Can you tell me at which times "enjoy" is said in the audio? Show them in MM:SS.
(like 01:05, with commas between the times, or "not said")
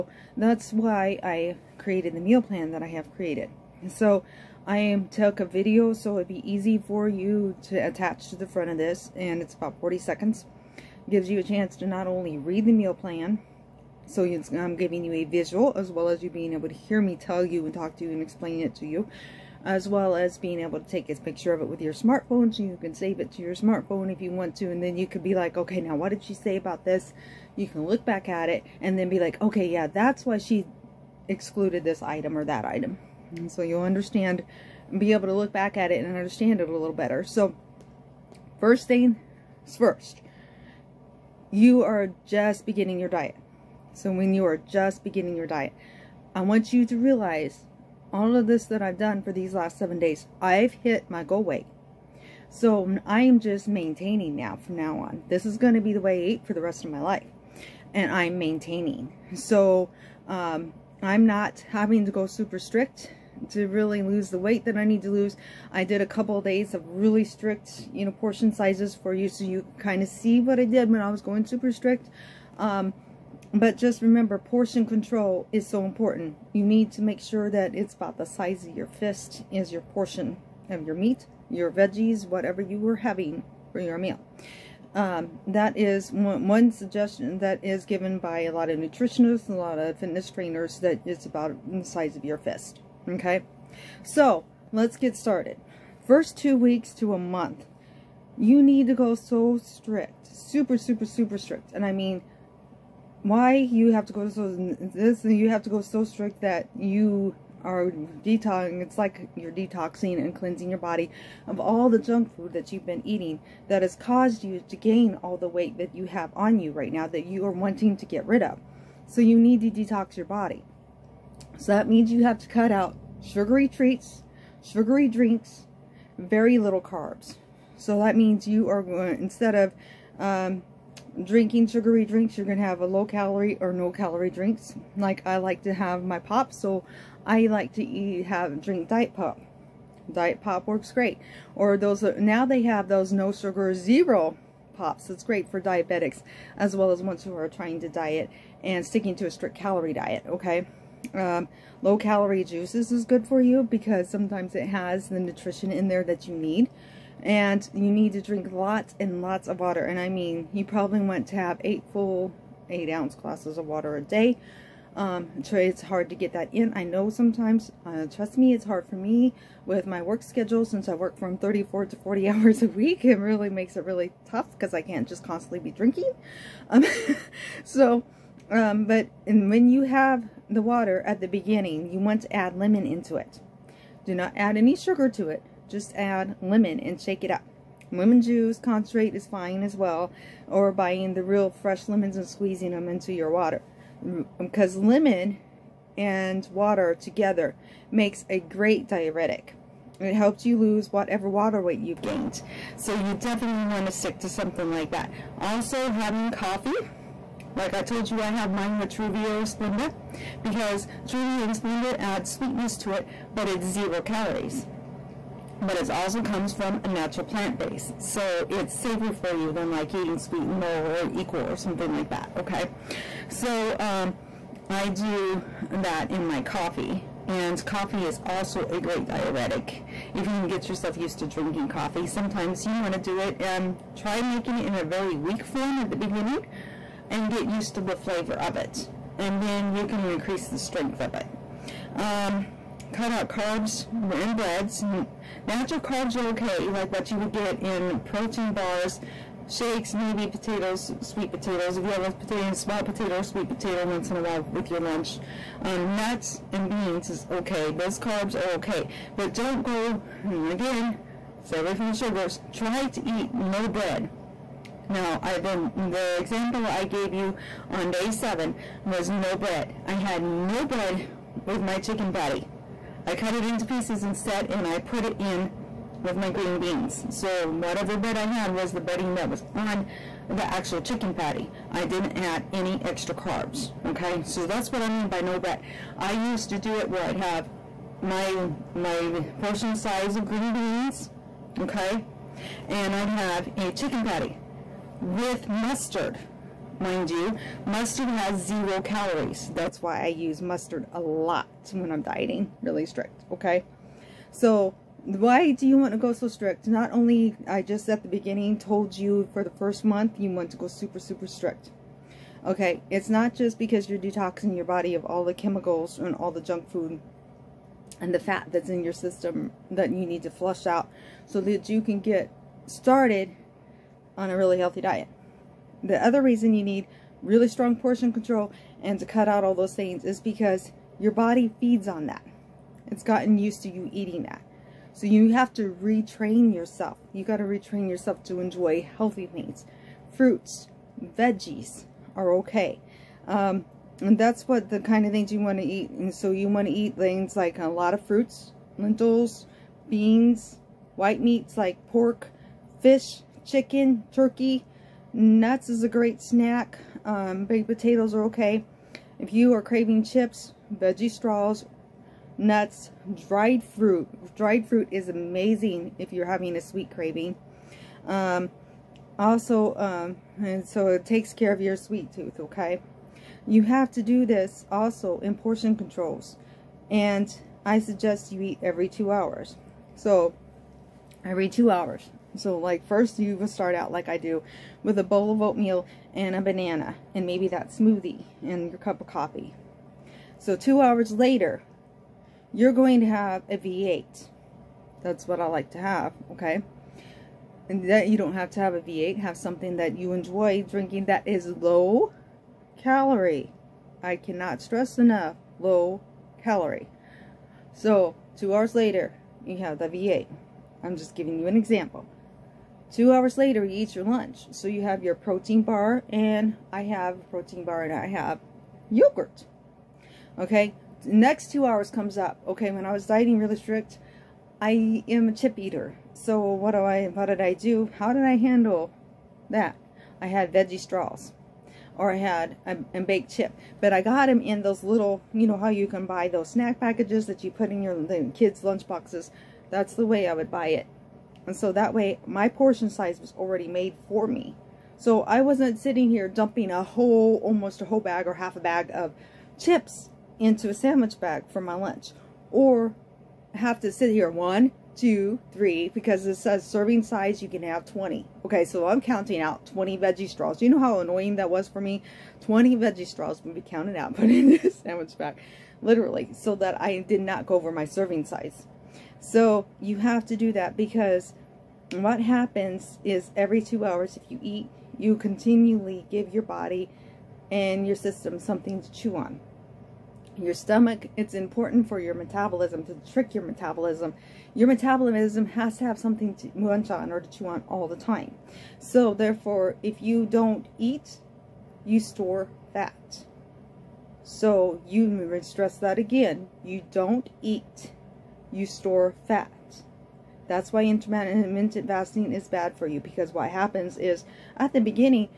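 05:38, 06:40.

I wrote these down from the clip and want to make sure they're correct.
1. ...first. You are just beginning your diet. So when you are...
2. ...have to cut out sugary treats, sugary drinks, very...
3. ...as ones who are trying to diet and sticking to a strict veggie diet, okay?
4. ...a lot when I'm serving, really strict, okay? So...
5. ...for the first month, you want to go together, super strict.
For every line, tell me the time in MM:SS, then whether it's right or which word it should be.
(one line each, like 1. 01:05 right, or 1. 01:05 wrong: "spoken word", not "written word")
1. 00:39 right
2. 02:02 right
3. 02:26 wrong: "calorie", not "veggie"
4. 05:00 wrong: "dieting", not "serving"
5. 05:09 wrong: "super", not "together".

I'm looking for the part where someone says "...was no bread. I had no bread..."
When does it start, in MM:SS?
04:28.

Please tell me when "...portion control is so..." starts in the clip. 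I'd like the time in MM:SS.
01:14.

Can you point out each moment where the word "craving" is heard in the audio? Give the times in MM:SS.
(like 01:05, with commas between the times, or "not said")
05:59, 06:06.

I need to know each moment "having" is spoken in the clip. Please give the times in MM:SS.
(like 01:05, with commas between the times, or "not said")
01:01, 01:22, 03:25, 06:06.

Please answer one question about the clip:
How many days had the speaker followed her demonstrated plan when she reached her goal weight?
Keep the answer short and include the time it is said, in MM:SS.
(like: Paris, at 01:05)
7, at 00:49.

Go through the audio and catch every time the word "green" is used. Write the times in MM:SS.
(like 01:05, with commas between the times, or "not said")
04:36, 04:50.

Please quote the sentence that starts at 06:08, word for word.
Um, also, um, and so it takes care of your sweet tooth, okay?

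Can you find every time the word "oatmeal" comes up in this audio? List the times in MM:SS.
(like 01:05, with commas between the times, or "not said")
06:25.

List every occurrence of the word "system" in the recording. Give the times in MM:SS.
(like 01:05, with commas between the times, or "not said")
05:18, 07:57.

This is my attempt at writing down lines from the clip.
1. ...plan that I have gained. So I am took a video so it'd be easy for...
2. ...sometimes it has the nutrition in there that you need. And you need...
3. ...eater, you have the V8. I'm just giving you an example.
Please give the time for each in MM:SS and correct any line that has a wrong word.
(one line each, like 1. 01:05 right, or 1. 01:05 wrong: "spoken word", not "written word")
1. 00:02 wrong: "created", not "gained"
2. 02:34 right
3. 06:48 wrong: "later", not "eater".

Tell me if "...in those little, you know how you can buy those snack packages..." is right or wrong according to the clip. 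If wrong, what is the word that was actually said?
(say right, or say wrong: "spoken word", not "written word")
right.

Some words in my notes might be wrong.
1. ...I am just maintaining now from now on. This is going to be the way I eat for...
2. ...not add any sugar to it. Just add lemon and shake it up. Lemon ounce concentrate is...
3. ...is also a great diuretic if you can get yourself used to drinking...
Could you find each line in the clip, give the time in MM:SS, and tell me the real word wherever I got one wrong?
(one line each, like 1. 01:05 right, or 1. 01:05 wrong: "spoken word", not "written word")
1. 00:53 right
2. 03:04 wrong: "juice", not "ounce"
3. 03:48 right.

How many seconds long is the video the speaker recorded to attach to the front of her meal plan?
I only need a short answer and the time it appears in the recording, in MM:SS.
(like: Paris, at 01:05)
40, at 00:09.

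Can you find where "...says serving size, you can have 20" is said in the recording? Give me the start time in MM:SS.
07:36.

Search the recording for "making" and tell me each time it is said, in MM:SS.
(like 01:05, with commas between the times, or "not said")
03:54.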